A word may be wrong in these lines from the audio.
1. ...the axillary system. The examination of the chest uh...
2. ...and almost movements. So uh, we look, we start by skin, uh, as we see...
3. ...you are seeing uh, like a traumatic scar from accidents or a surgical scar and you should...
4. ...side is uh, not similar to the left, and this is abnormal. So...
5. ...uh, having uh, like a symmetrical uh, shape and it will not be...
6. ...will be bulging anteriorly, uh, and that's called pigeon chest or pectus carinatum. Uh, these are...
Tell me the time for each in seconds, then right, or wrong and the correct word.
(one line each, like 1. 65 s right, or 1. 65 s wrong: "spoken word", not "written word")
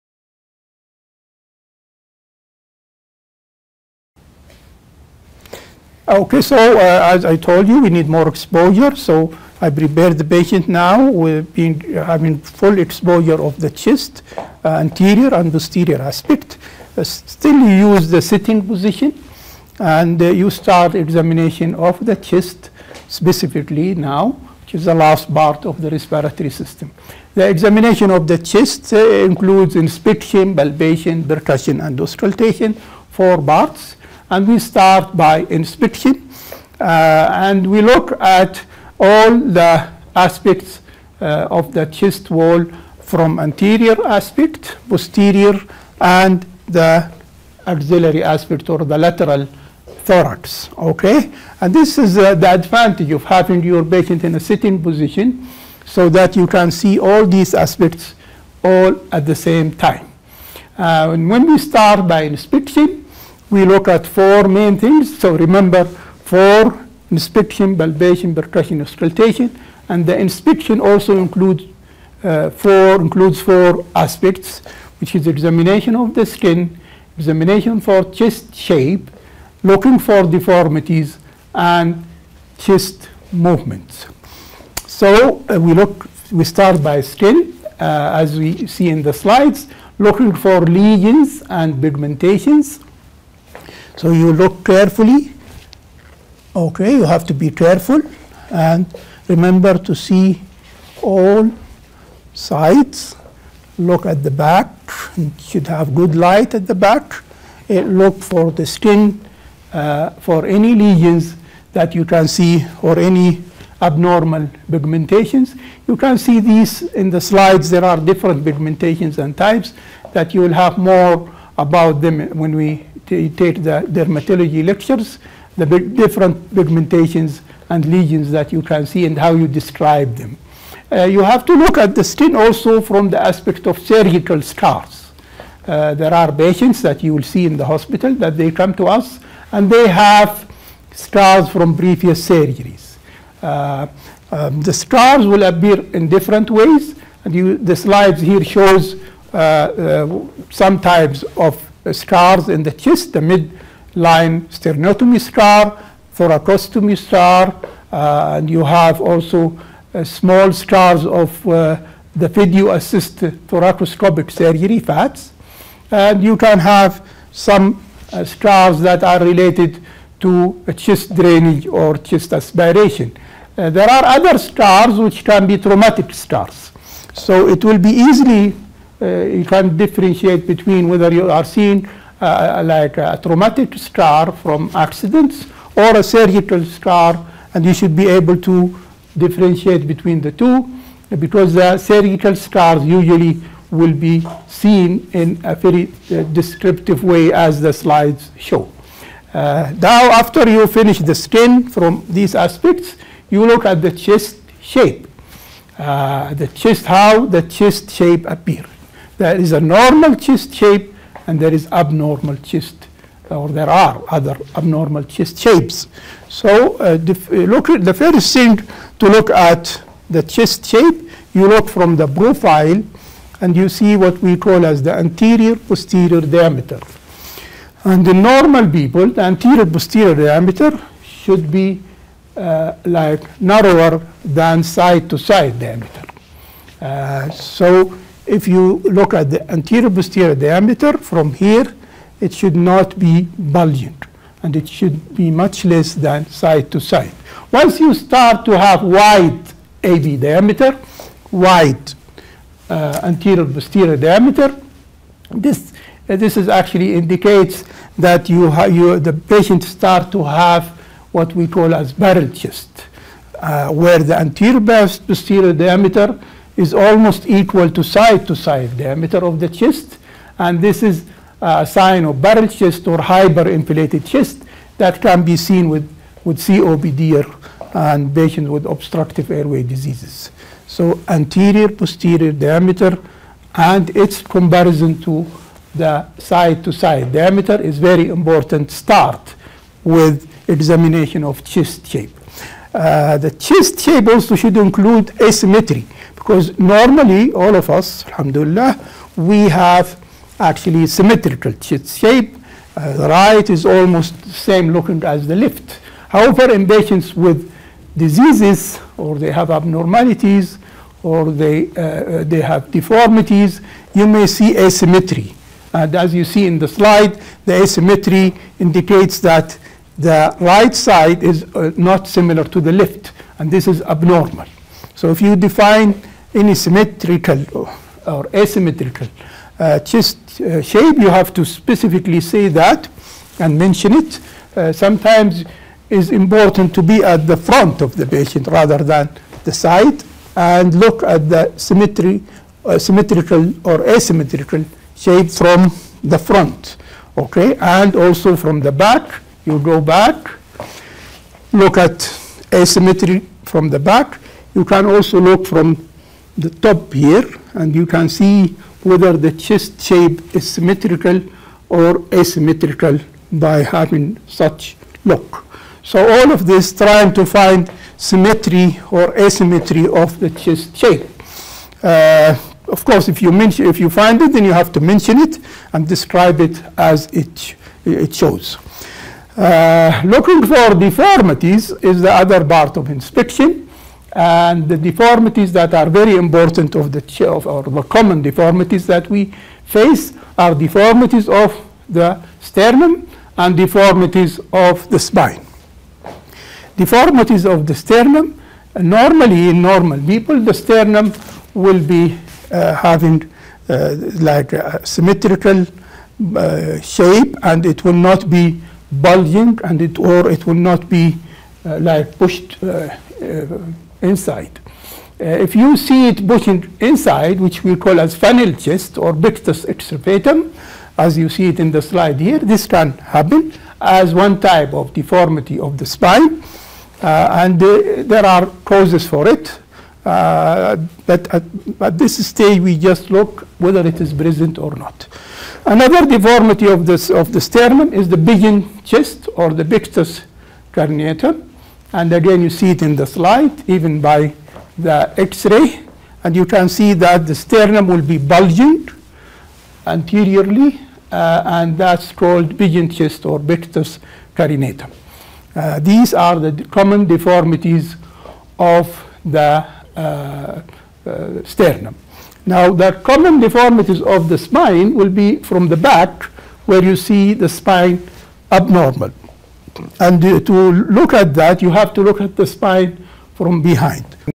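1. 25 s wrong: "respiratory", not "axillary"
2. 81 s wrong: "chest", not "almost"
3. 181 s right
4. 320 s right
5. 402 s right
6. 447 s right.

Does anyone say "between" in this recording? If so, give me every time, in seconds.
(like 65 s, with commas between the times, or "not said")
180 s, 189 s.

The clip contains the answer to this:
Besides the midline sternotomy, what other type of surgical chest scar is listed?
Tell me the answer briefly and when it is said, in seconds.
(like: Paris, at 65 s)
thoracostomy, at 156 s.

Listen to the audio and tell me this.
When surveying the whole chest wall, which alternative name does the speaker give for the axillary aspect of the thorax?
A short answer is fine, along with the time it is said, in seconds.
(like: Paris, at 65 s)
lateral thorax, at 48 s.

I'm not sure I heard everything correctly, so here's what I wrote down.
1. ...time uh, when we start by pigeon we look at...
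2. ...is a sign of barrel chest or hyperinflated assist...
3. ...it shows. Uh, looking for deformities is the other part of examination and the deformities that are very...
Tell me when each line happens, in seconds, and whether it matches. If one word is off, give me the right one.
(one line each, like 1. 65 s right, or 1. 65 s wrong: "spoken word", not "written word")
1. 59 s wrong: "inspection", not "pigeon"
2. 270 s wrong: "chest", not "assist"
3. 377 s wrong: "inspection", not "examination".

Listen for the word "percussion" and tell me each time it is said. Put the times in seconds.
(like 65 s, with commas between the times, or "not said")
31 s, 68 s.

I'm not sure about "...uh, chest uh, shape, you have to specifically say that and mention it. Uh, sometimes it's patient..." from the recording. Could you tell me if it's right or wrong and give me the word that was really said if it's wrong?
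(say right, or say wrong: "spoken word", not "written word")
wrong: "important", not "patient".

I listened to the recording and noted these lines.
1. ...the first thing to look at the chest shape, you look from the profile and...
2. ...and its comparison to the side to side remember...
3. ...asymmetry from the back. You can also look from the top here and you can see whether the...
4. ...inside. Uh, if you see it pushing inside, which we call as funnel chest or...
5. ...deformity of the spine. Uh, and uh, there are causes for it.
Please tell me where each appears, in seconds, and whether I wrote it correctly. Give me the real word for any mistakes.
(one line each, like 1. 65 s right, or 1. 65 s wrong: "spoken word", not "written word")
1. 217 s right
2. 283 s wrong: "diameter", not "remember"
3. 352 s right
4. 414 s right
5. 424 s right.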